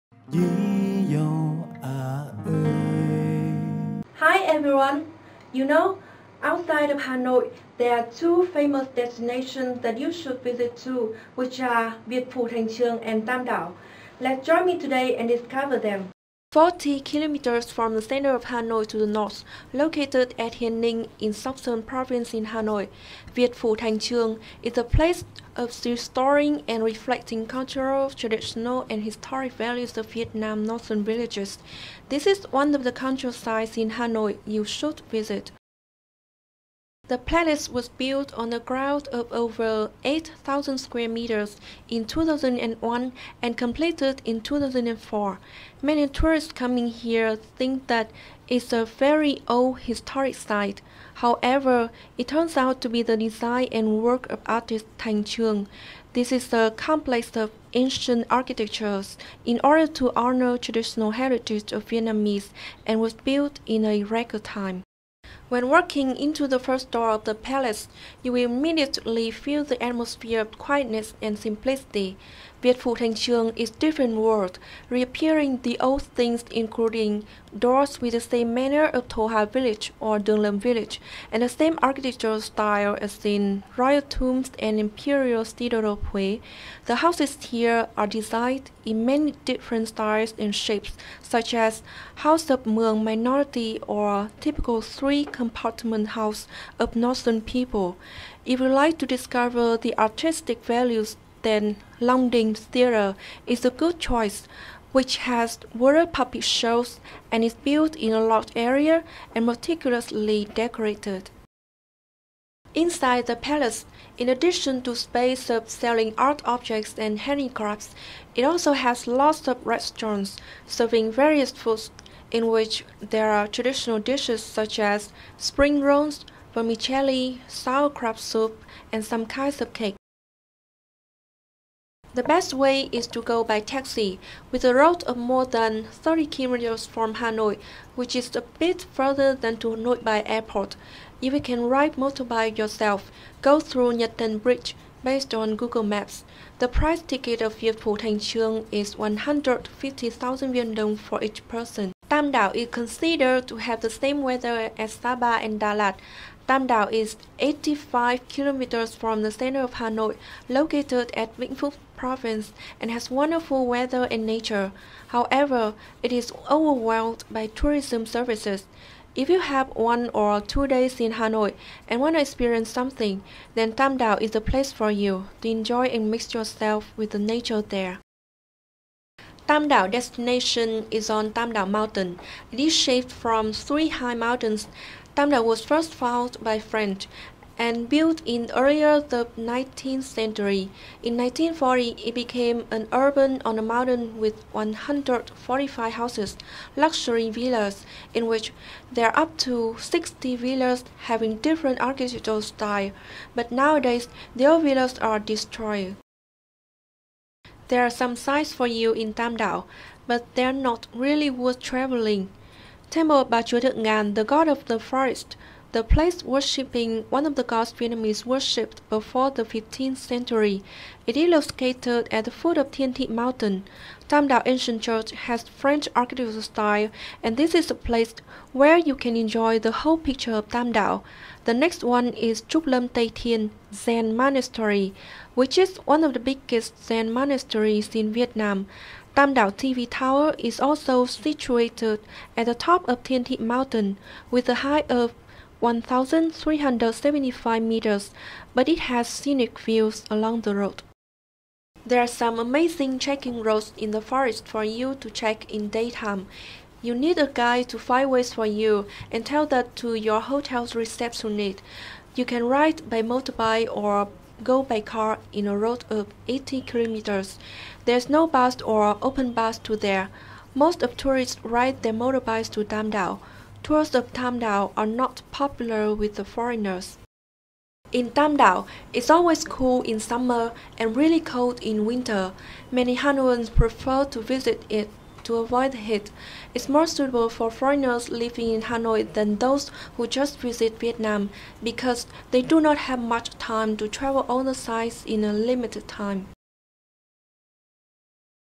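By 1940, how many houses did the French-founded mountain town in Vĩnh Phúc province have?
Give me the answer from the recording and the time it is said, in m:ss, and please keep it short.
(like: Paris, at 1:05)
145, at 3:14.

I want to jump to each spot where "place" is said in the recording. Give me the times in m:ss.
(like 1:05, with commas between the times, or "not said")
0:24, 2:54, 3:35, 3:47.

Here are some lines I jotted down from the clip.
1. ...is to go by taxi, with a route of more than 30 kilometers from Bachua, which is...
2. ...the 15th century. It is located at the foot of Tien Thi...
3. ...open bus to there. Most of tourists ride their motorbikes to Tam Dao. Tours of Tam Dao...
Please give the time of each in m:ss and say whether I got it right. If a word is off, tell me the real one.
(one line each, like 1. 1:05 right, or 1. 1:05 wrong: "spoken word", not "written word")
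1. 2:12 wrong: "Hanoi", not "Bachua"
2. 3:39 right
3. 4:29 right.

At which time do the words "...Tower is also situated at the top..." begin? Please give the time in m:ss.
3:59.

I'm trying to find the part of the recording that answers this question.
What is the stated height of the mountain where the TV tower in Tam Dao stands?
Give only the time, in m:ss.
4:05.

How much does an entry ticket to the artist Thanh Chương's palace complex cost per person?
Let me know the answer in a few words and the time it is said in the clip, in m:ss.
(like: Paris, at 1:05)
150,000 Viet Dong, at 2:28.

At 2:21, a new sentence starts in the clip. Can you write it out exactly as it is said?
If you can ride motorbike yourself, go through Nhat Tan Bridge based on Google Maps.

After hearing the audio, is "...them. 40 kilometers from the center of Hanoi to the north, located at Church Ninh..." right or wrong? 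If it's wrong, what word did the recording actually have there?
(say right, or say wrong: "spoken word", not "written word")
wrong: "Hien", not "Church".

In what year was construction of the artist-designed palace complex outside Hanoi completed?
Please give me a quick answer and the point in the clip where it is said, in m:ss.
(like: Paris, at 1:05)
2004, at 0:44.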